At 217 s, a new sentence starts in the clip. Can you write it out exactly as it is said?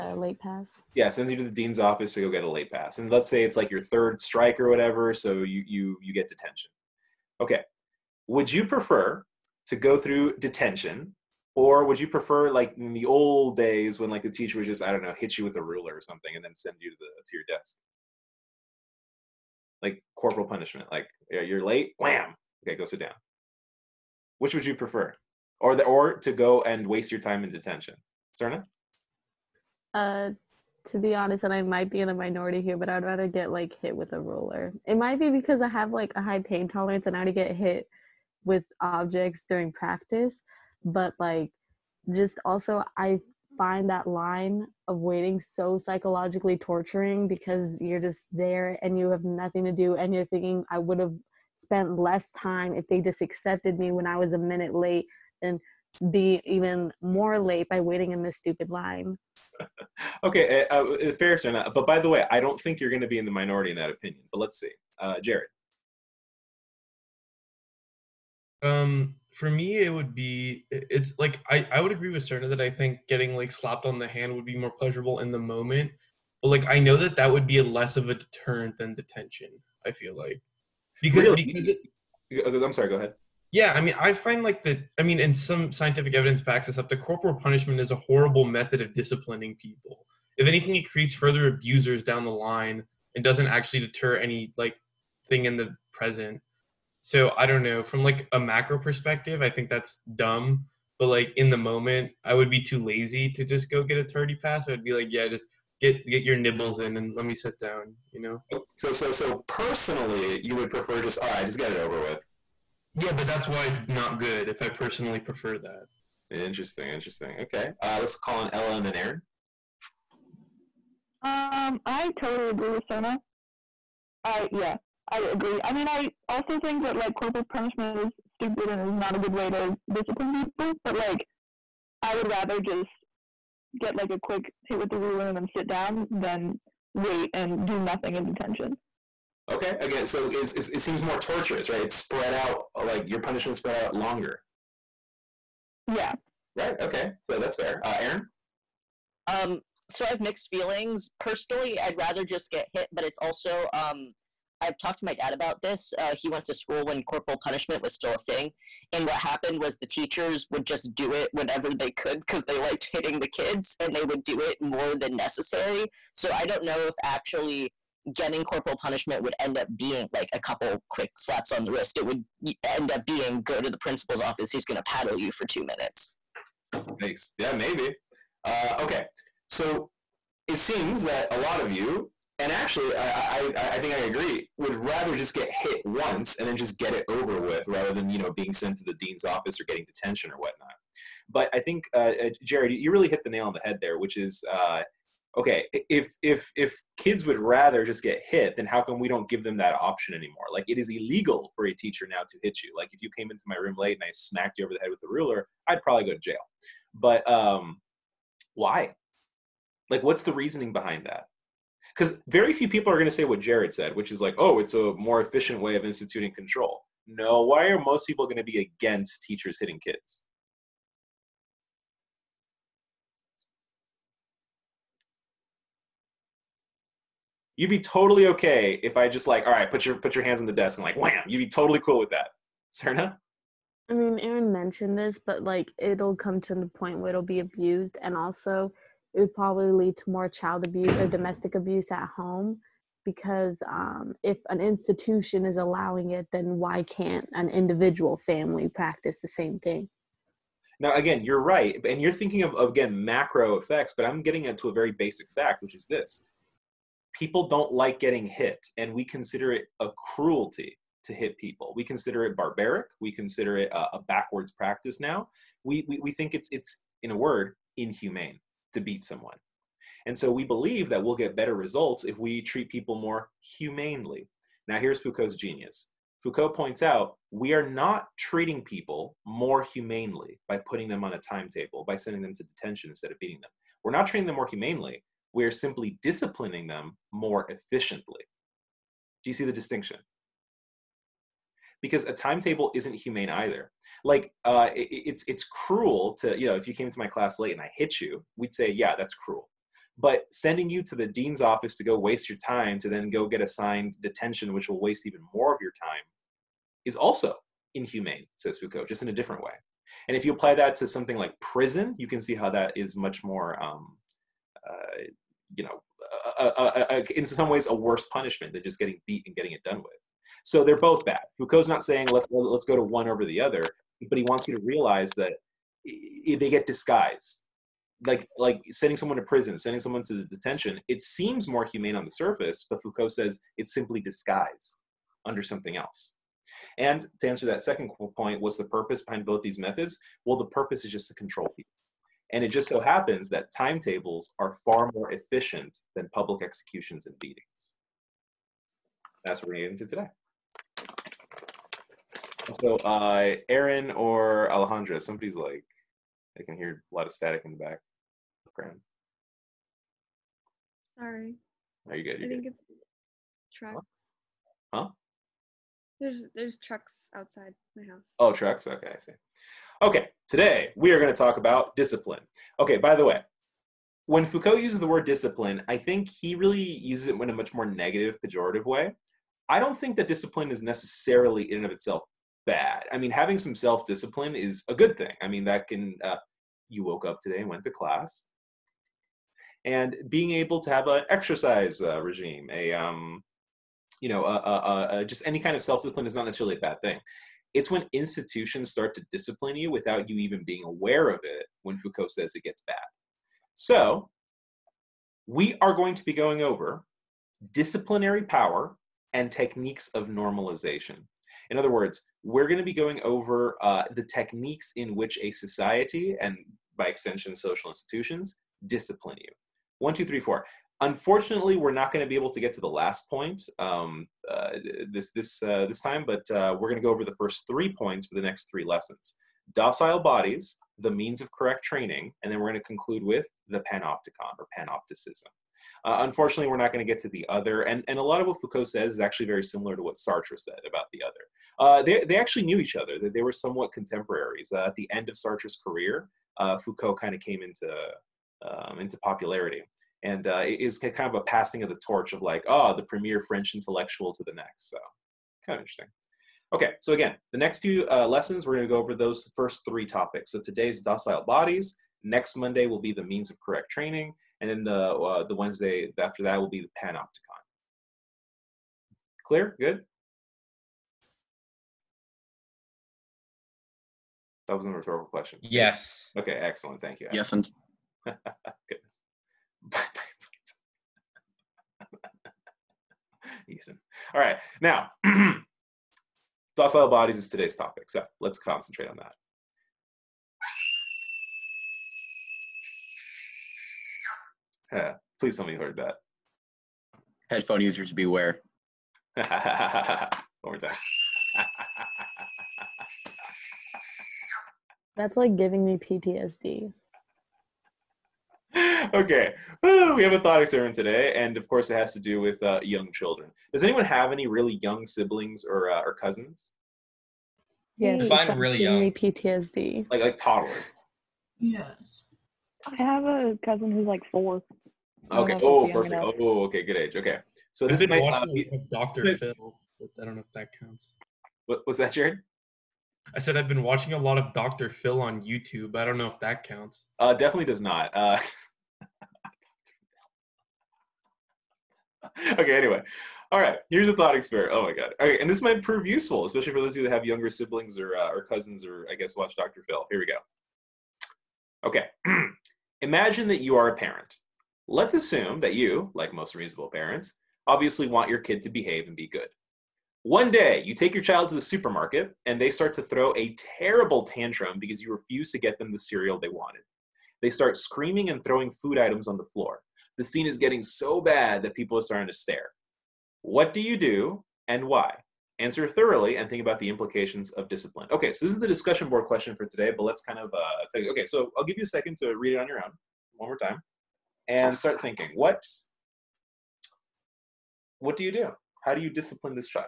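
No, why are most people going to be against teachers hitting kids?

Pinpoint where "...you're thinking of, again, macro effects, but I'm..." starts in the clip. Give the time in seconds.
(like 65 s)
252 s.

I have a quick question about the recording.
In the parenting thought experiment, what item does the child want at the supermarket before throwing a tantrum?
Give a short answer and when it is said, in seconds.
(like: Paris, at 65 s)
Cereal, at 565 s.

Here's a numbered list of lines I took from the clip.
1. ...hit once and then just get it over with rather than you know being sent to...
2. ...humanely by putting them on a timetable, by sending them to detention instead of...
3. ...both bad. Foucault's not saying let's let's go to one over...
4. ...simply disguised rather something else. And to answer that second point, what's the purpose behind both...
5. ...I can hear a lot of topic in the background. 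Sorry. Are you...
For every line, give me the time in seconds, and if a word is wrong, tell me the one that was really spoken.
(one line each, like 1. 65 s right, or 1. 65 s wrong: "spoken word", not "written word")
1. 185 s right
2. 279 s right
3. 320 s right
4. 333 s wrong: "under", not "rather"
5. 356 s wrong: "static", not "topic".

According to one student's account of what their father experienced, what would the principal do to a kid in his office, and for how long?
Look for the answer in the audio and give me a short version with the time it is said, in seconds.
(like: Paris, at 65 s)
Paddle you for two minutes, at 174 s.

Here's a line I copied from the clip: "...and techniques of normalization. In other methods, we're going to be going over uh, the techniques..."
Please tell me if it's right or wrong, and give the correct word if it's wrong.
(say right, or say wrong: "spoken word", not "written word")
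wrong: "words", not "methods".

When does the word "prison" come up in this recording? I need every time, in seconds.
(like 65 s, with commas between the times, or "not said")
311 s, 329 s.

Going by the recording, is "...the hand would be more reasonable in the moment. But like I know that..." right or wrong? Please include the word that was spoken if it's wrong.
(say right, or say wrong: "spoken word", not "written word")
wrong: "pleasurable", not "reasonable".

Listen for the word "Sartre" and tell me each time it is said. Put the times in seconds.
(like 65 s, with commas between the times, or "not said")
439 s, 445 s.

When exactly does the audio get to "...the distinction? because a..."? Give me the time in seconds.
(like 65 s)
289 s.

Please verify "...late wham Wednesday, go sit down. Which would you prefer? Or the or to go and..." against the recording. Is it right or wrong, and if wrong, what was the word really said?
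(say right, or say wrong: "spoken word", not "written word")
wrong: "Okay", not "Wednesday".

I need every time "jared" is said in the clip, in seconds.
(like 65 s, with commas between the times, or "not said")
65 s, 192 s, 213 s, 531 s.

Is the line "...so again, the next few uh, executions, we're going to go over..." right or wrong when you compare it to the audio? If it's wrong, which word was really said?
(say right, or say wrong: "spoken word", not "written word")
wrong: "lessons", not "executions".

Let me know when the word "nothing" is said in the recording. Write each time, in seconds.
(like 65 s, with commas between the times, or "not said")
49 s, 137 s.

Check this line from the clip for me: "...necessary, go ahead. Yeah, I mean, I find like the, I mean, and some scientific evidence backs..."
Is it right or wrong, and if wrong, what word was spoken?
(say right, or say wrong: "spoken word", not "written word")
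wrong: "sorry", not "necessary".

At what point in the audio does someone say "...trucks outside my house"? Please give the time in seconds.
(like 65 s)
366 s.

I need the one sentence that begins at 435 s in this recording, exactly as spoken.
Uh, unfortunately, we're not going to get to the other.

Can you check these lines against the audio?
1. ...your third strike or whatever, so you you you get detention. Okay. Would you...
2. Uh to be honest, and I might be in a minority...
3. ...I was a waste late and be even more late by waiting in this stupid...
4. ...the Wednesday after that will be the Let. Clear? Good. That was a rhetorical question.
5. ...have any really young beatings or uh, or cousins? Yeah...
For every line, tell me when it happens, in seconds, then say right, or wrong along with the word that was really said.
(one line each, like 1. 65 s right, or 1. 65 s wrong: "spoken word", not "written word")
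1. 3 s right
2. 29 s right
3. 54 s wrong: "minute", not "waste"
4. 465 s wrong: "Panopticon", not "Let"
5. 513 s wrong: "siblings", not "beatings".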